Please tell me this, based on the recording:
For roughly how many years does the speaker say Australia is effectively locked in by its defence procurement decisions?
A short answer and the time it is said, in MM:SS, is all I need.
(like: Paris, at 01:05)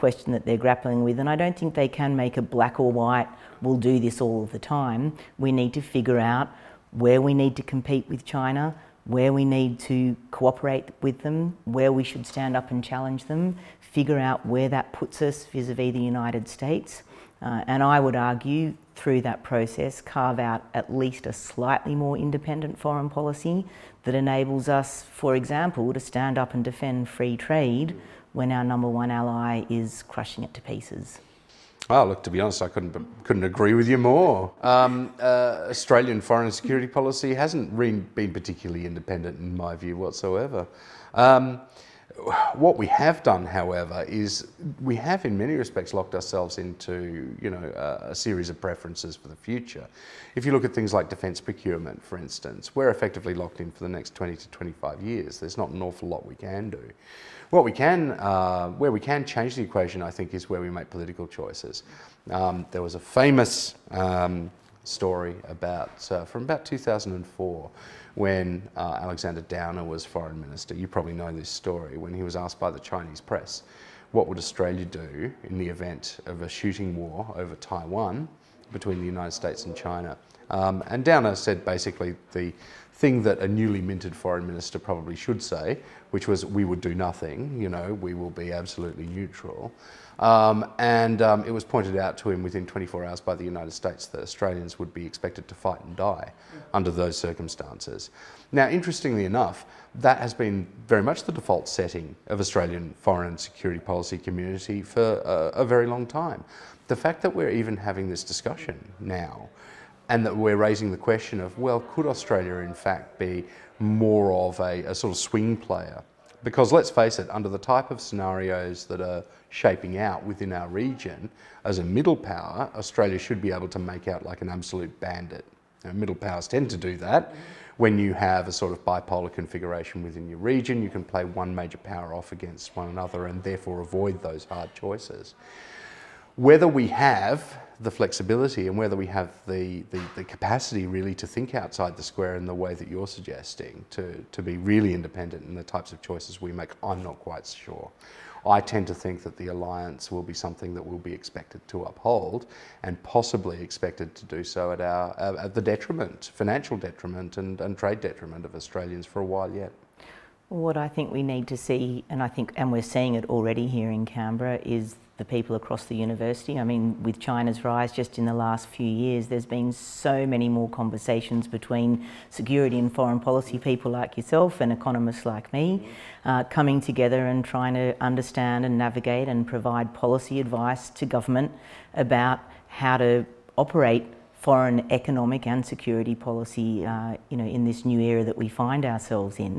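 20 to 25 years, at 00:54.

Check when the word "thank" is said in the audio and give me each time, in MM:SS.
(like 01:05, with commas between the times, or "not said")
not said.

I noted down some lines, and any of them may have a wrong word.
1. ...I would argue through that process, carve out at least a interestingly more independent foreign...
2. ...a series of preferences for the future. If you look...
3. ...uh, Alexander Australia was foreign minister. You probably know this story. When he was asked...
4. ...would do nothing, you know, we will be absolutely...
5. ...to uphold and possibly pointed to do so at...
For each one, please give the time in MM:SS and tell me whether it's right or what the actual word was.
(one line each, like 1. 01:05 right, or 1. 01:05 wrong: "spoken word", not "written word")
1. 00:17 wrong: "slightly", not "interestingly"
2. 00:48 right
3. 01:08 wrong: "Downer", not "Australia"
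4. 01:26 right
5. 02:31 wrong: "expected", not "pointed".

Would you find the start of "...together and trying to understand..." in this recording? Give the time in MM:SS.
02:56.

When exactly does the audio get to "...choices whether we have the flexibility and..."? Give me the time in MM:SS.
02:14.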